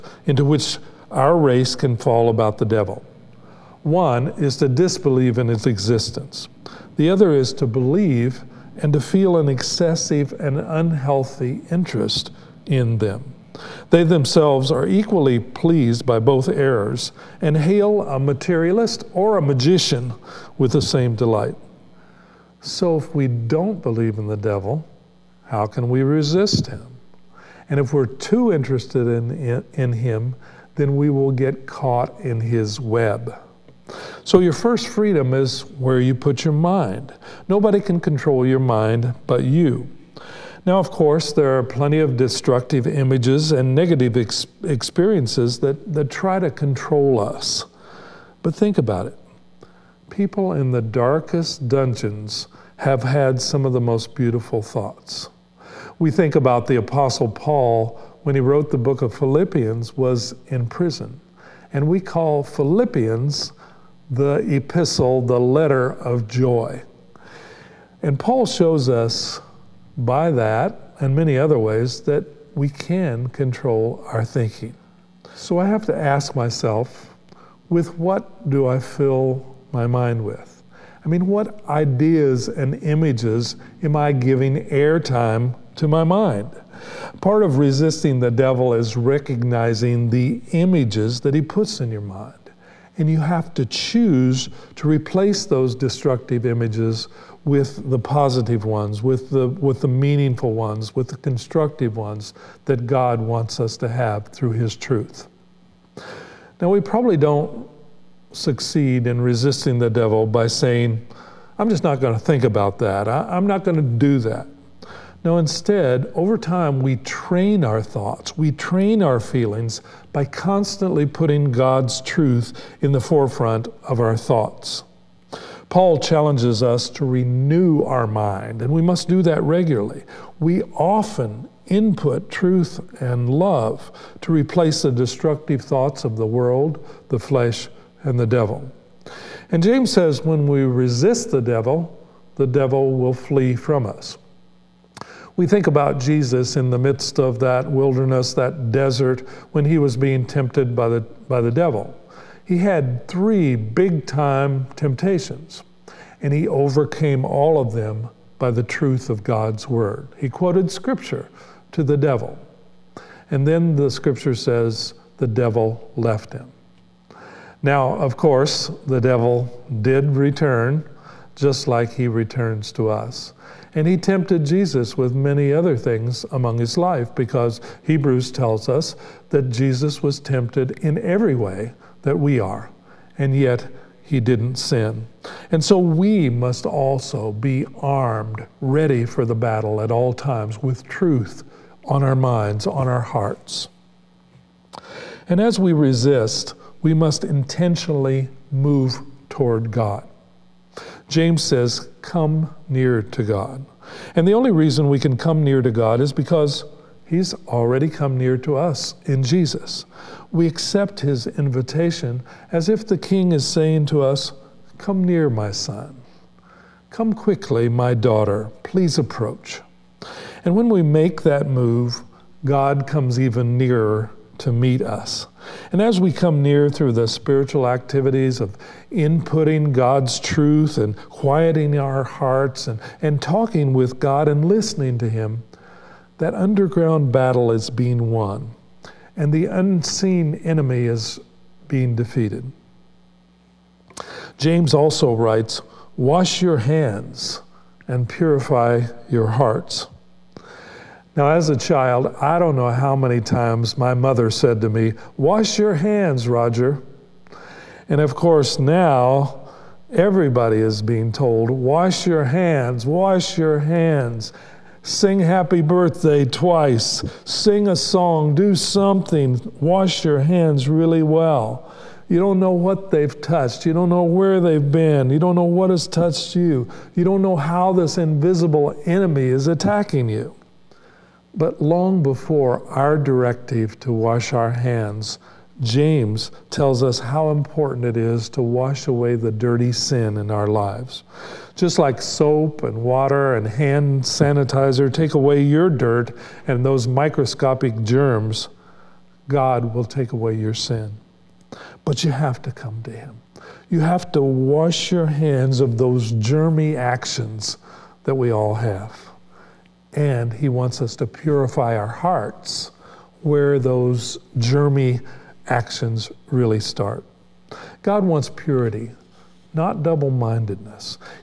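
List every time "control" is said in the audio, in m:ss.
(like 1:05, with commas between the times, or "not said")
0:38, 0:46, 1:13.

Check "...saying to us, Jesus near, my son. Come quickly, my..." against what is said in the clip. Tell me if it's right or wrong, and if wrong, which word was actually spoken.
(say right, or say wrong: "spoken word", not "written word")
wrong: "Come", not "Jesus".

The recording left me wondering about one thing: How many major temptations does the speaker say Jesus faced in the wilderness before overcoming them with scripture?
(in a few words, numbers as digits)
3.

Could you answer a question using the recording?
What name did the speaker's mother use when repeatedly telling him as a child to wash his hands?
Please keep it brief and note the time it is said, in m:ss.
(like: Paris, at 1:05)
Roger, at 4:16.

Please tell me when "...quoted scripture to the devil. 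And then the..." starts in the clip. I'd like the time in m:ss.
2:40.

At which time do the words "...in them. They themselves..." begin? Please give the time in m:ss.
0:12.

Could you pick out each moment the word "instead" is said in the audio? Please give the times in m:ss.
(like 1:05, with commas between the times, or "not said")
1:55.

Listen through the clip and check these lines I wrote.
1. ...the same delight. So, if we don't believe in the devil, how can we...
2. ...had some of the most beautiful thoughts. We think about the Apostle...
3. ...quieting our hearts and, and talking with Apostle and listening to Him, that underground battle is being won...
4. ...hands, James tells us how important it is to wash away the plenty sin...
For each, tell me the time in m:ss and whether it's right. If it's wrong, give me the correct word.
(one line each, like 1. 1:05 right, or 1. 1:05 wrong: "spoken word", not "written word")
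1. 0:20 right
2. 0:53 right
3. 3:51 wrong: "God", not "Apostle"
4. 4:44 wrong: "dirty", not "plenty".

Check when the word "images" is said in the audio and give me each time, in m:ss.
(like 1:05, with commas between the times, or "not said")
0:42, 1:22, 1:30, 1:36.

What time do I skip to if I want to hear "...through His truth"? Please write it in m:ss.
1:44.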